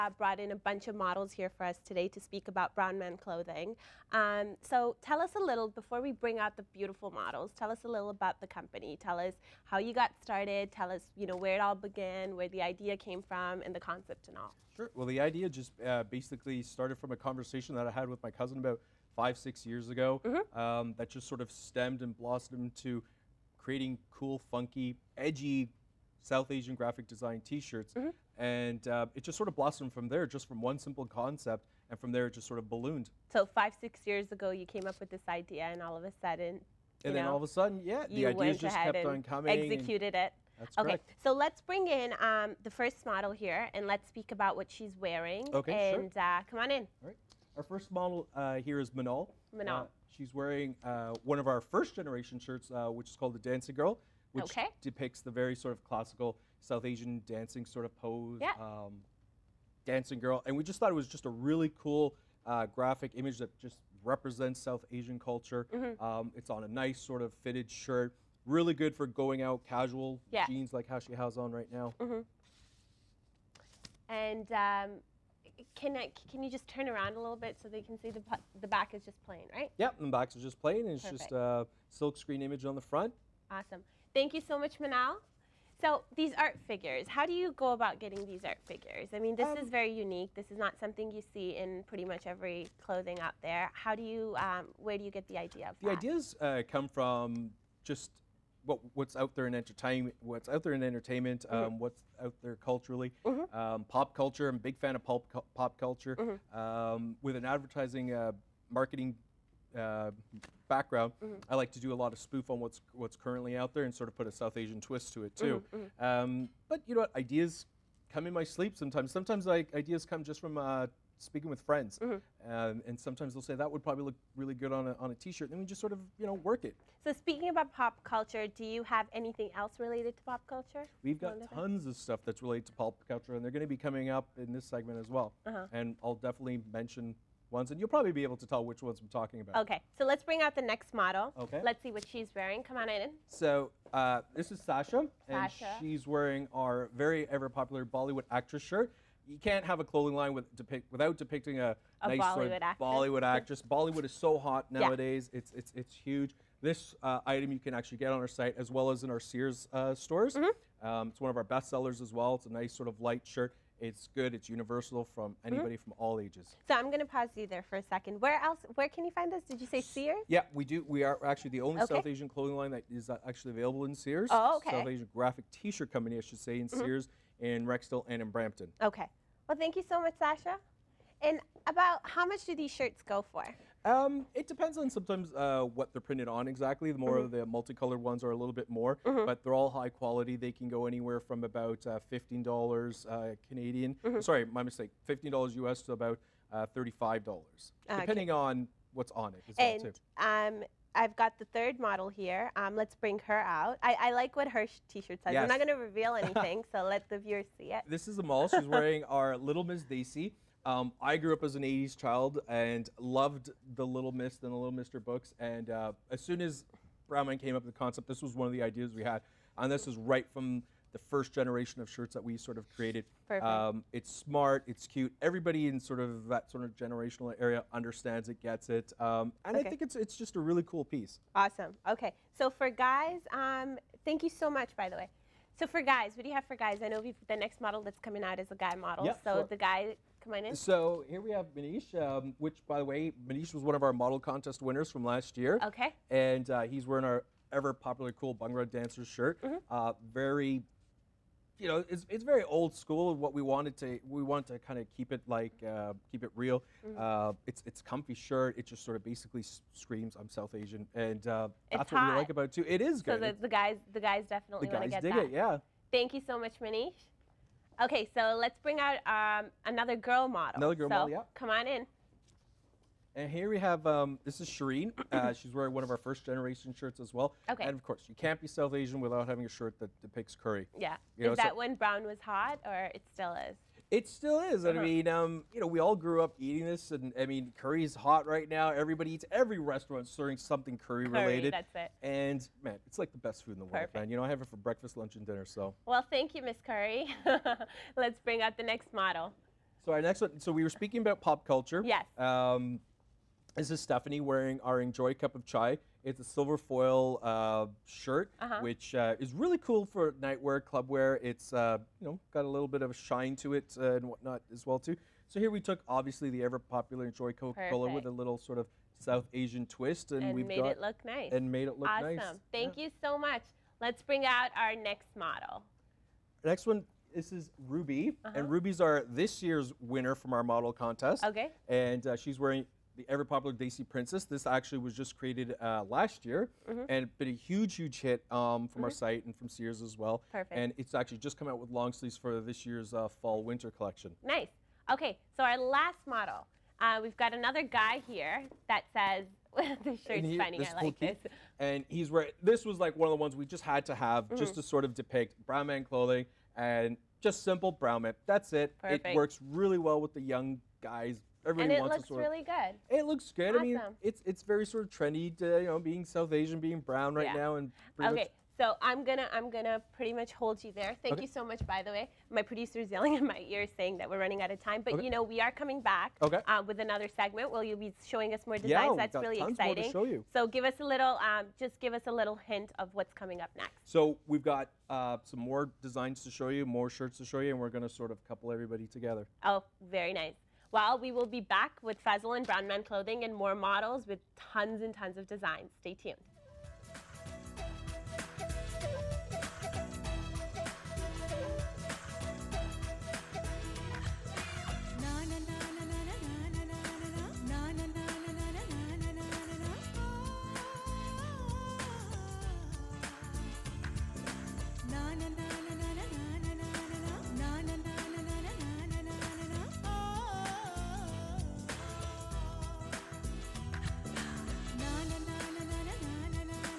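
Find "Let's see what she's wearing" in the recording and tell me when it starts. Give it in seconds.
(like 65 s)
141 s.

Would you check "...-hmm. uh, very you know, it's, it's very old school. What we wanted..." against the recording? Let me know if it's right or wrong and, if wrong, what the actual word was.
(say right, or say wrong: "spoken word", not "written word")
right.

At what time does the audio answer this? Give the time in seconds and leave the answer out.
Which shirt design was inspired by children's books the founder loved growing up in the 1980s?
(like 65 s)
209 s.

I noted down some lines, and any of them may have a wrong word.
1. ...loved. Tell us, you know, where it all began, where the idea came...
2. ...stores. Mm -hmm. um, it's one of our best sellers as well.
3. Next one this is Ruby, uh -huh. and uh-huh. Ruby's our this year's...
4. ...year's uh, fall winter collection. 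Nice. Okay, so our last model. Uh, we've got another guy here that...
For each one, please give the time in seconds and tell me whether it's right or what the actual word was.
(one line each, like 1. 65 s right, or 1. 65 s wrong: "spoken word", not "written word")
1. 10 s wrong: "started", not "loved"
2. 159 s right
3. 326 s right
4. 342 s right.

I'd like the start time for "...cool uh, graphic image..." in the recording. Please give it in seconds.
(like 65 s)
61 s.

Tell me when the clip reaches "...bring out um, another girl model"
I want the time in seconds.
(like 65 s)
268 s.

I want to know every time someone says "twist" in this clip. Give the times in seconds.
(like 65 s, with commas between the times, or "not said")
114 s, 319 s.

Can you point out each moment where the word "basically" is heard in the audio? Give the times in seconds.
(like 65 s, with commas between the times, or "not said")
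16 s, 259 s.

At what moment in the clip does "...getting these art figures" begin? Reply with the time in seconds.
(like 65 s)
87 s.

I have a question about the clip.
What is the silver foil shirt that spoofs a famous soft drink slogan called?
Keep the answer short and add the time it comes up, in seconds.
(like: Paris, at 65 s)
Enjoy Cup of Chai, at 304 s.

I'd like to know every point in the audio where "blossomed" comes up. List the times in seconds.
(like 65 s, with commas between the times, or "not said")
22 s, 29 s.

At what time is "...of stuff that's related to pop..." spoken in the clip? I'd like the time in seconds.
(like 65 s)
131 s.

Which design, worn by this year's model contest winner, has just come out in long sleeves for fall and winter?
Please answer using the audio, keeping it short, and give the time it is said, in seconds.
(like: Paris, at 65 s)
Desi Princess, at 333 s.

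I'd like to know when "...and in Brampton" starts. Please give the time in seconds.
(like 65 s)
178 s.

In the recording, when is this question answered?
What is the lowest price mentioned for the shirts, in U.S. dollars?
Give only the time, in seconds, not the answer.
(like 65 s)
195 s.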